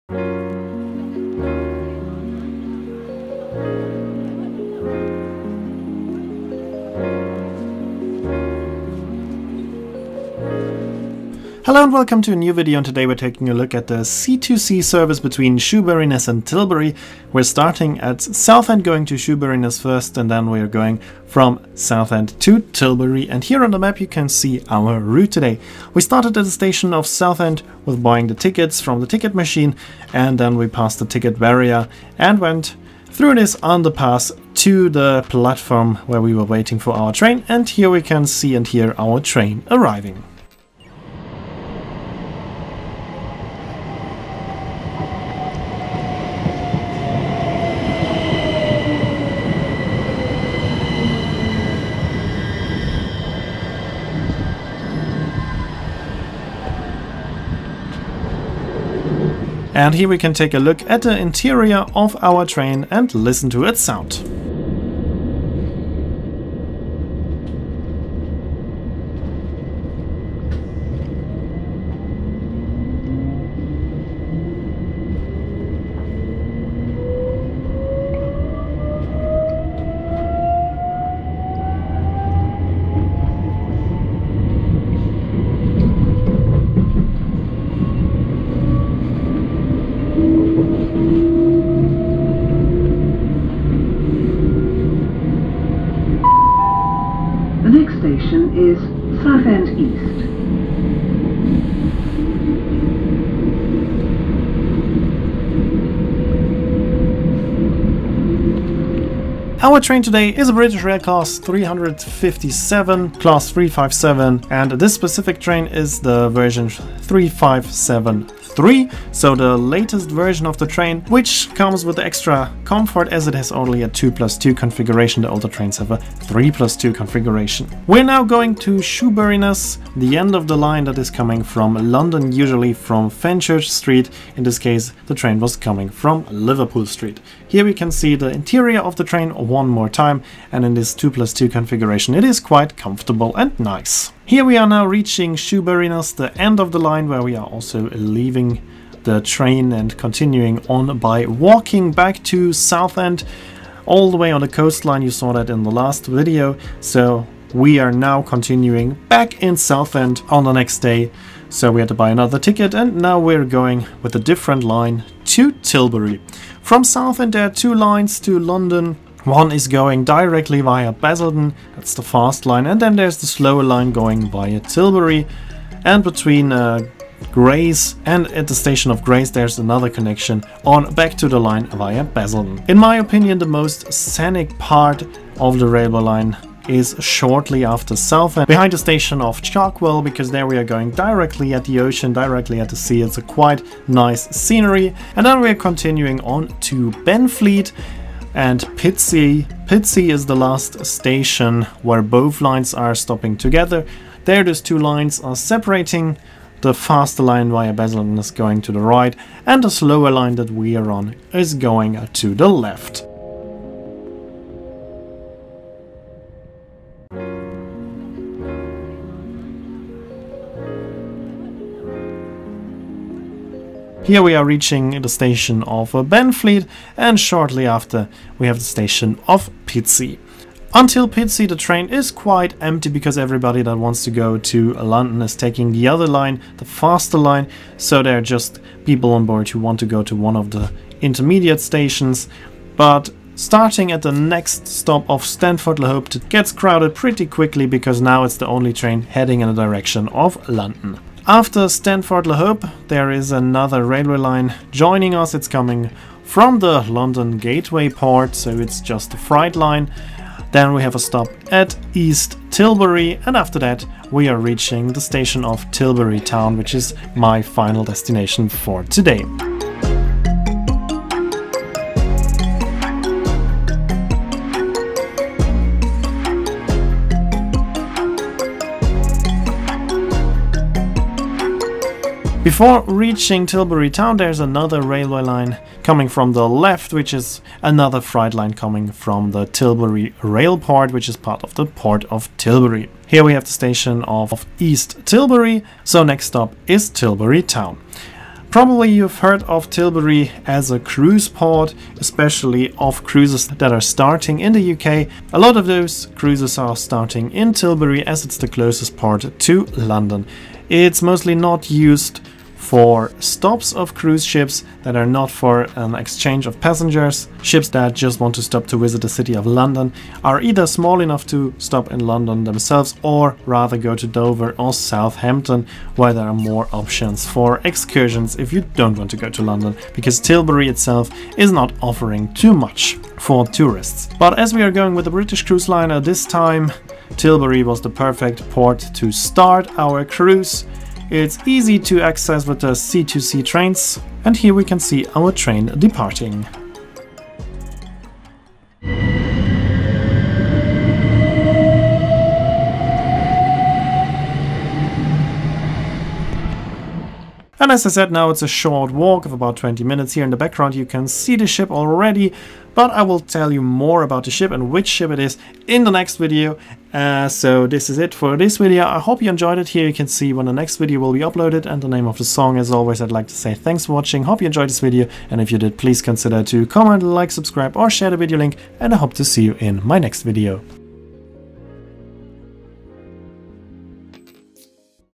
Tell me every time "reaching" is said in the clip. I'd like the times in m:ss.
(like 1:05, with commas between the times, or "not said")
2:24, 3:44, 4:24, 4:42.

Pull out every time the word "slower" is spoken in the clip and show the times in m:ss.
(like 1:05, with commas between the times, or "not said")
2:53, 3:29.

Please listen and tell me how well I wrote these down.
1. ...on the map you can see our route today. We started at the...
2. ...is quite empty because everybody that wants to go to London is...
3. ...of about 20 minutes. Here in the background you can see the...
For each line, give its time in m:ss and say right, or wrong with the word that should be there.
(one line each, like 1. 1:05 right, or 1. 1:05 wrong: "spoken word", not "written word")
1. 0:23 right
2. 3:51 right
3. 5:59 right.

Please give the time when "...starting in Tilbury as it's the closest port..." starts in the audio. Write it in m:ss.
5:06.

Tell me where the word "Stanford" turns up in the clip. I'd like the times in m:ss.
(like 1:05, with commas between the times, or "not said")
4:05, 4:11.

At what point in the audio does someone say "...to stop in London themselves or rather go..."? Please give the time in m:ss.
5:21.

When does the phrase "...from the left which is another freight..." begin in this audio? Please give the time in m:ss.
4:46.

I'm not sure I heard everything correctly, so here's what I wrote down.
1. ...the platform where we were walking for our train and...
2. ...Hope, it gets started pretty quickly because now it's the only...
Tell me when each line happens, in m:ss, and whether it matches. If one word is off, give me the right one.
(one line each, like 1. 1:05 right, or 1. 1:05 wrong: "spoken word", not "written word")
1. 0:34 wrong: "waiting", not "walking"
2. 4:05 wrong: "crowded", not "started".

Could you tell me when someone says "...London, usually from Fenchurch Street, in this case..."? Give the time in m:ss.
2:11.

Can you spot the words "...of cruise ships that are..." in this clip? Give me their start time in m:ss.
5:13.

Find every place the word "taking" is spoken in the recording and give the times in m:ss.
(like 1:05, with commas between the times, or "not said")
0:13, 3:55.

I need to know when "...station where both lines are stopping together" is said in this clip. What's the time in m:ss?
3:20.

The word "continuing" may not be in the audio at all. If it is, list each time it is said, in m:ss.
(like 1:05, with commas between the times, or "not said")
2:29, 2:38, 3:15.